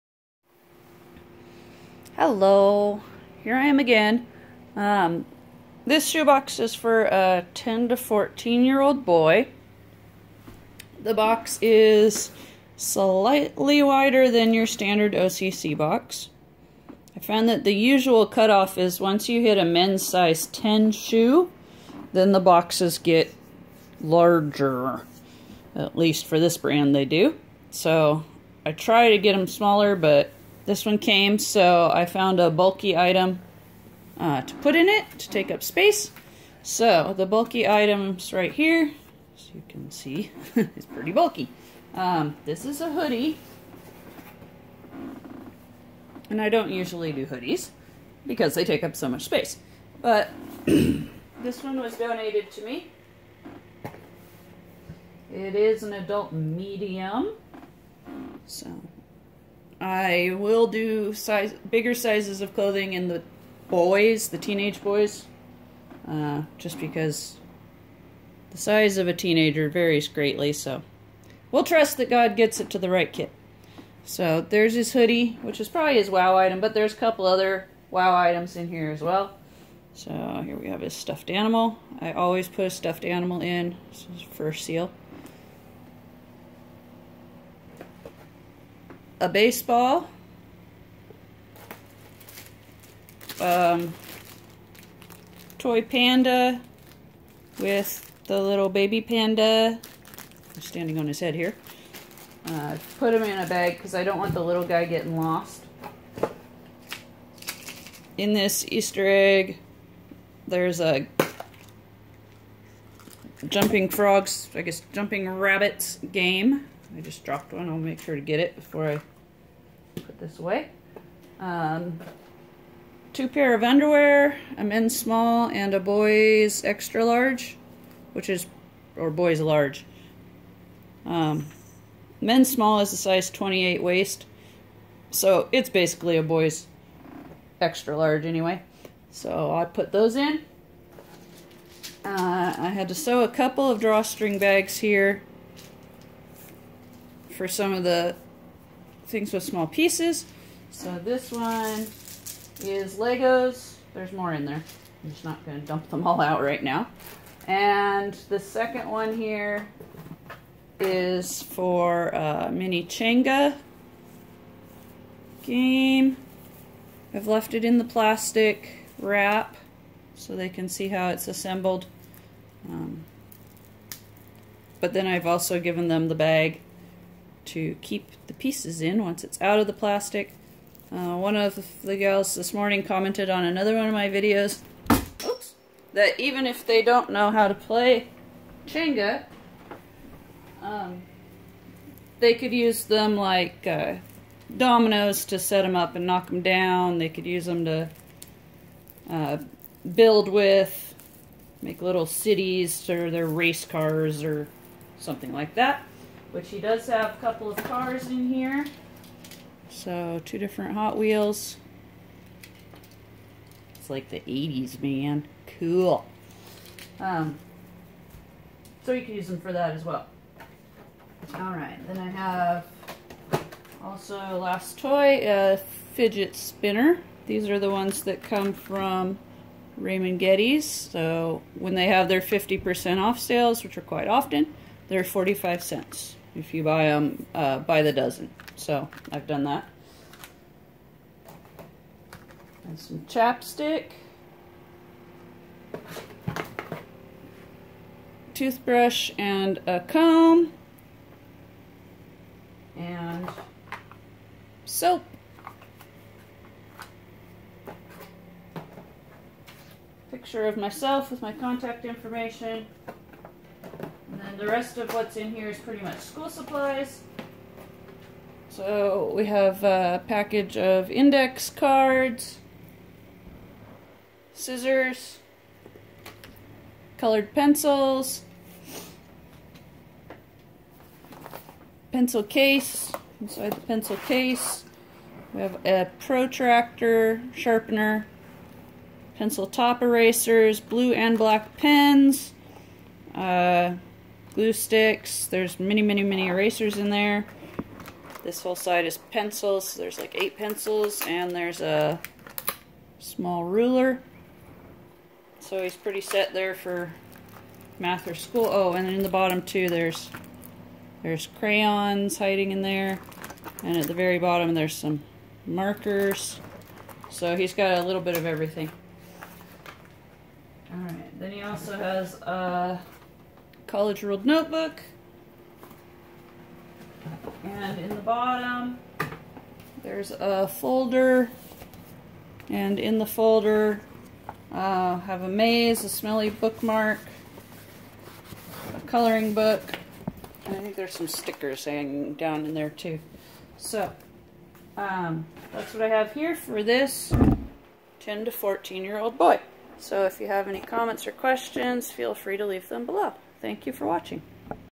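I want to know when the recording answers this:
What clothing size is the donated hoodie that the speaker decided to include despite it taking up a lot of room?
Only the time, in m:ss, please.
0:55.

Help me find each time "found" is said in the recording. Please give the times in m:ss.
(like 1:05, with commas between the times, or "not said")
0:17, 0:32.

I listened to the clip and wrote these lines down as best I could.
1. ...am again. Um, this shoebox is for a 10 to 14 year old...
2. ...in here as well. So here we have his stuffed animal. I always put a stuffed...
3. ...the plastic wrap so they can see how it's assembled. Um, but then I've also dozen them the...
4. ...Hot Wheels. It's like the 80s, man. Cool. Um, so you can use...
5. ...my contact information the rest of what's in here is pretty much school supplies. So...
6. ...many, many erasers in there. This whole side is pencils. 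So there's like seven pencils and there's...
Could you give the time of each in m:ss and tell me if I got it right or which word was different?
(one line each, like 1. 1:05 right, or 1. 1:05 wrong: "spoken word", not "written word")
1. 0:03 right
2. 1:18 right
3. 2:47 wrong: "given", not "dozen"
4. 3:30 right
5. 4:21 right
6. 4:55 wrong: "eight", not "seven".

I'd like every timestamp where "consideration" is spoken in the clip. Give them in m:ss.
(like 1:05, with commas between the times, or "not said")
not said.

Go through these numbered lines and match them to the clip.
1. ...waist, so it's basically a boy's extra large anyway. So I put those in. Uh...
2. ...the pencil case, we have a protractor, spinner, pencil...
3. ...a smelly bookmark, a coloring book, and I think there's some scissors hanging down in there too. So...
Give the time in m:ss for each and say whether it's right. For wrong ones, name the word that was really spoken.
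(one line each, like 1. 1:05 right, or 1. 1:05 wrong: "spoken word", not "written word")
1. 2:13 right
2. 4:43 wrong: "sharpener", not "spinner"
3. 5:35 wrong: "stickers", not "scissors".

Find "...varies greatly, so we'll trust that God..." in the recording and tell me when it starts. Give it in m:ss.
1:09.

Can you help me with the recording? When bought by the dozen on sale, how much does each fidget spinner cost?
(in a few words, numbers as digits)
45 cents.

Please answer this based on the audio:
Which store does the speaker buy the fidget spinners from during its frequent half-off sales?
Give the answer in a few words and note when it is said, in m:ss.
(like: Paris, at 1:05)
Raymond Getty's, at 3:49.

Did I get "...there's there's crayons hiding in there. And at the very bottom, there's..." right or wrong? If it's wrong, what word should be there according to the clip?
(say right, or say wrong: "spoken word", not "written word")
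right.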